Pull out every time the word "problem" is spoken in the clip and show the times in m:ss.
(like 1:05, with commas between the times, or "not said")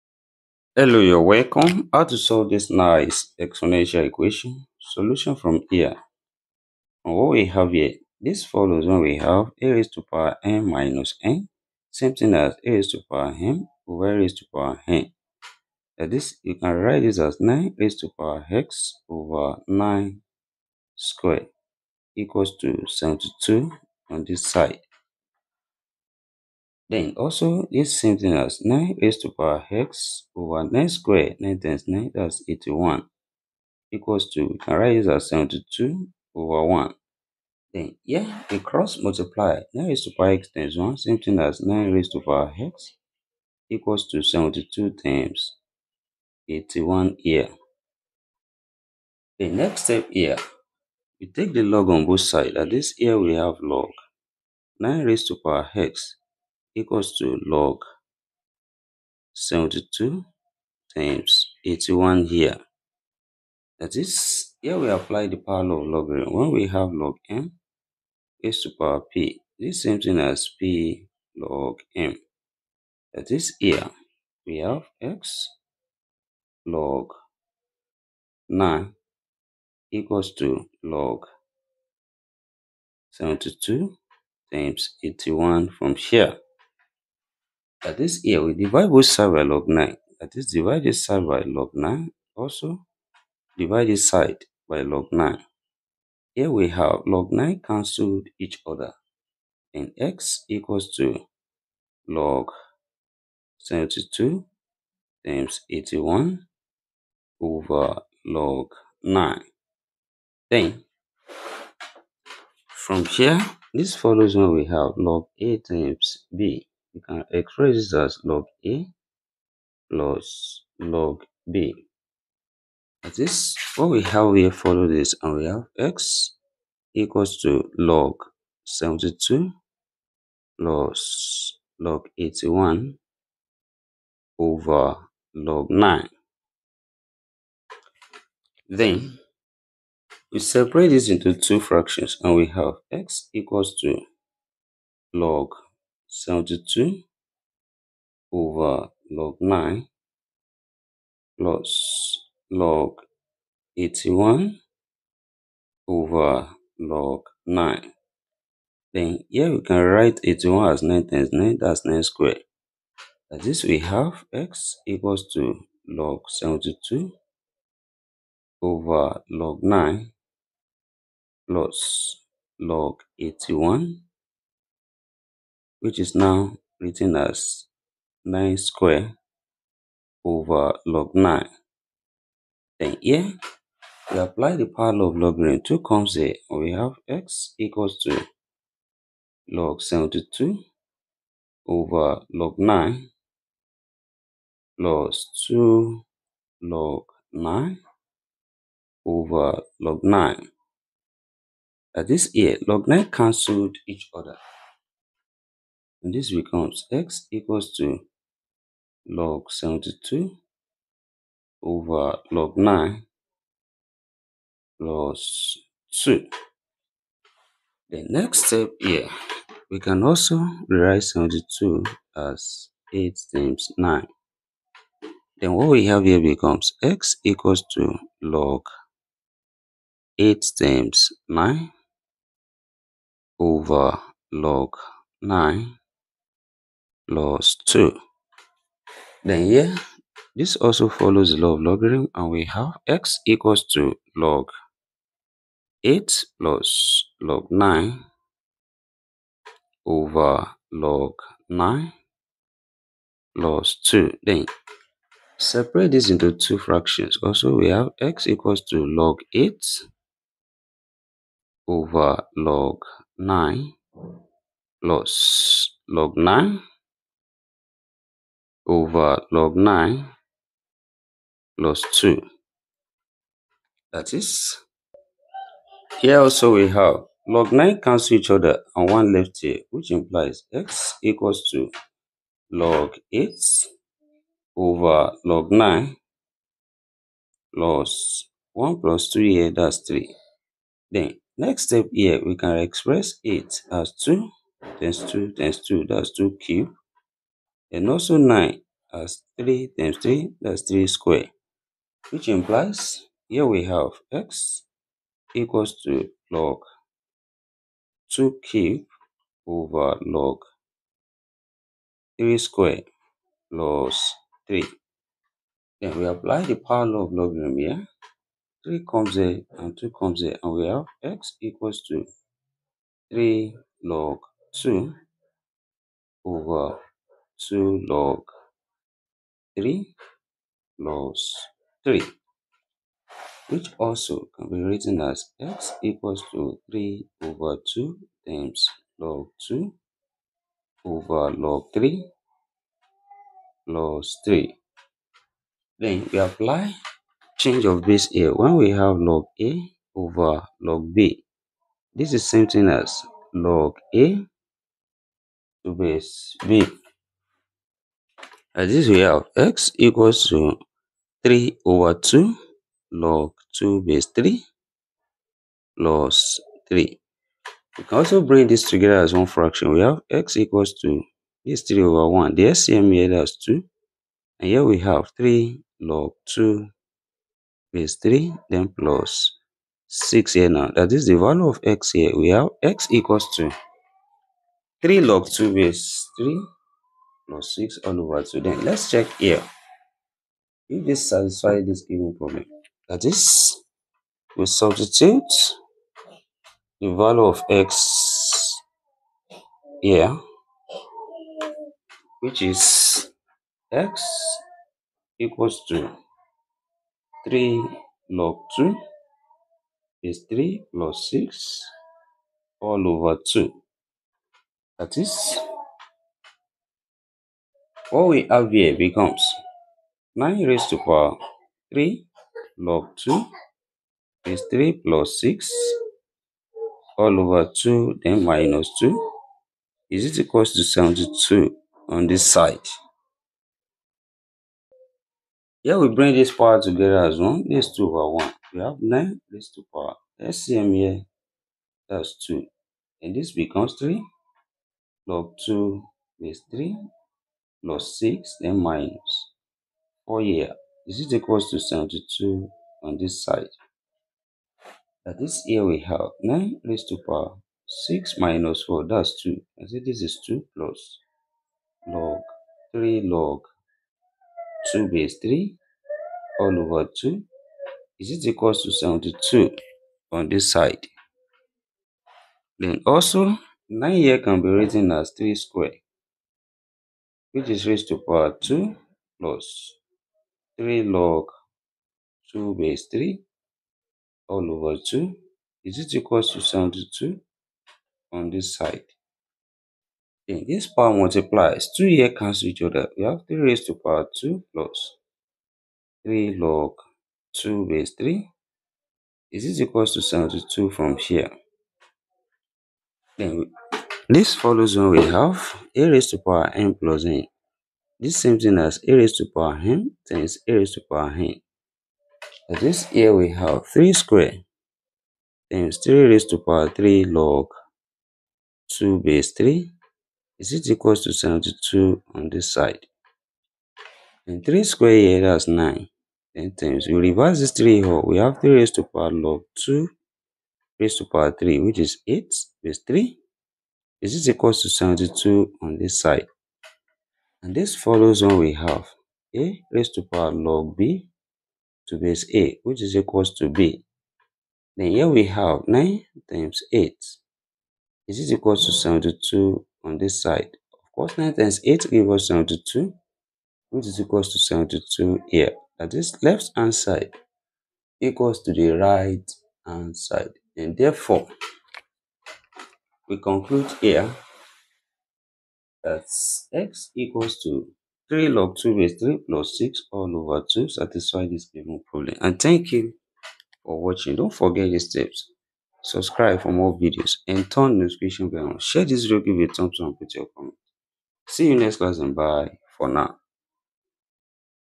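6:32, 9:31.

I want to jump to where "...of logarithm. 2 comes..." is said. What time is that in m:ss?
3:05.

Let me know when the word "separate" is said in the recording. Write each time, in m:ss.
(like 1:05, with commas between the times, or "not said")
2:20, 4:15.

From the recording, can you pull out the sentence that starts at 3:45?
Then what we have here becomes x equals to log 8 times 9 over log 9 plus 2.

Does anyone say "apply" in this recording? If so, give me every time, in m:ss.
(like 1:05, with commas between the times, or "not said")
1:04, 3:04, 5:16, 5:46.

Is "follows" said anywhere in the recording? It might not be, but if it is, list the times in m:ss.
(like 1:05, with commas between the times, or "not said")
0:08, 1:53, 2:04, 4:00, 8:24, 8:57.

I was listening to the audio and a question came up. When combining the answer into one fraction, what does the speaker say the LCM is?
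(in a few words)
2.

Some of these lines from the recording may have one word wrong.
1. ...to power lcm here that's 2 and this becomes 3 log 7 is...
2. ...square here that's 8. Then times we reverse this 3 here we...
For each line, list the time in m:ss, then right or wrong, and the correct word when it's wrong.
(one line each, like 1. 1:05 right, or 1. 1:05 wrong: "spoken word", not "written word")
1. 7:19 wrong: "2", not "7"
2. 8:44 wrong: "9", not "8".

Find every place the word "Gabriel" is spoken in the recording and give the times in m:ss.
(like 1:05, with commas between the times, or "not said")
not said.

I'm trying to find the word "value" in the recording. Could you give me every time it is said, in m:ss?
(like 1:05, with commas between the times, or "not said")
6:21, 6:36.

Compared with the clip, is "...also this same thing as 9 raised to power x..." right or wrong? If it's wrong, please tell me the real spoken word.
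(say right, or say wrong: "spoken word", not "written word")
right.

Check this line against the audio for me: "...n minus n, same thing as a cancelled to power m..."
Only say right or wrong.
wrong.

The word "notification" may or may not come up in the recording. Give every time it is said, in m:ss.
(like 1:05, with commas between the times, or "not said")
9:37.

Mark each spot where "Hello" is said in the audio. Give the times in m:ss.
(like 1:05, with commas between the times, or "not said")
0:00.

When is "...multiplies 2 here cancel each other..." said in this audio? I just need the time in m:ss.
8:10.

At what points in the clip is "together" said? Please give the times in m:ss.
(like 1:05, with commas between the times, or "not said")
6:08, 7:16.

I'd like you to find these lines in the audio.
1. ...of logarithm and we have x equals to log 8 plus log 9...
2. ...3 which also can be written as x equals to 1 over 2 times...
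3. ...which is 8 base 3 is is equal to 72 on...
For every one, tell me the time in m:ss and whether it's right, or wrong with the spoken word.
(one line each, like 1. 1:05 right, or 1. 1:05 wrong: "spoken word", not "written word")
1. 4:01 right
2. 5:31 wrong: "3", not "1"
3. 8:51 right.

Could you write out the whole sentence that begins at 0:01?
How to solve this nice exponential equation?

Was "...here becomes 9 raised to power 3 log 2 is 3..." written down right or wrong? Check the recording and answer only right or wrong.
right.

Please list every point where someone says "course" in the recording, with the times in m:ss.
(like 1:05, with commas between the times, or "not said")
9:10.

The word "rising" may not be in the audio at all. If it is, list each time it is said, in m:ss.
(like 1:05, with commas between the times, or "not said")
not said.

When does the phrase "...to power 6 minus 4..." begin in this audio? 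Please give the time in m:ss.
7:36.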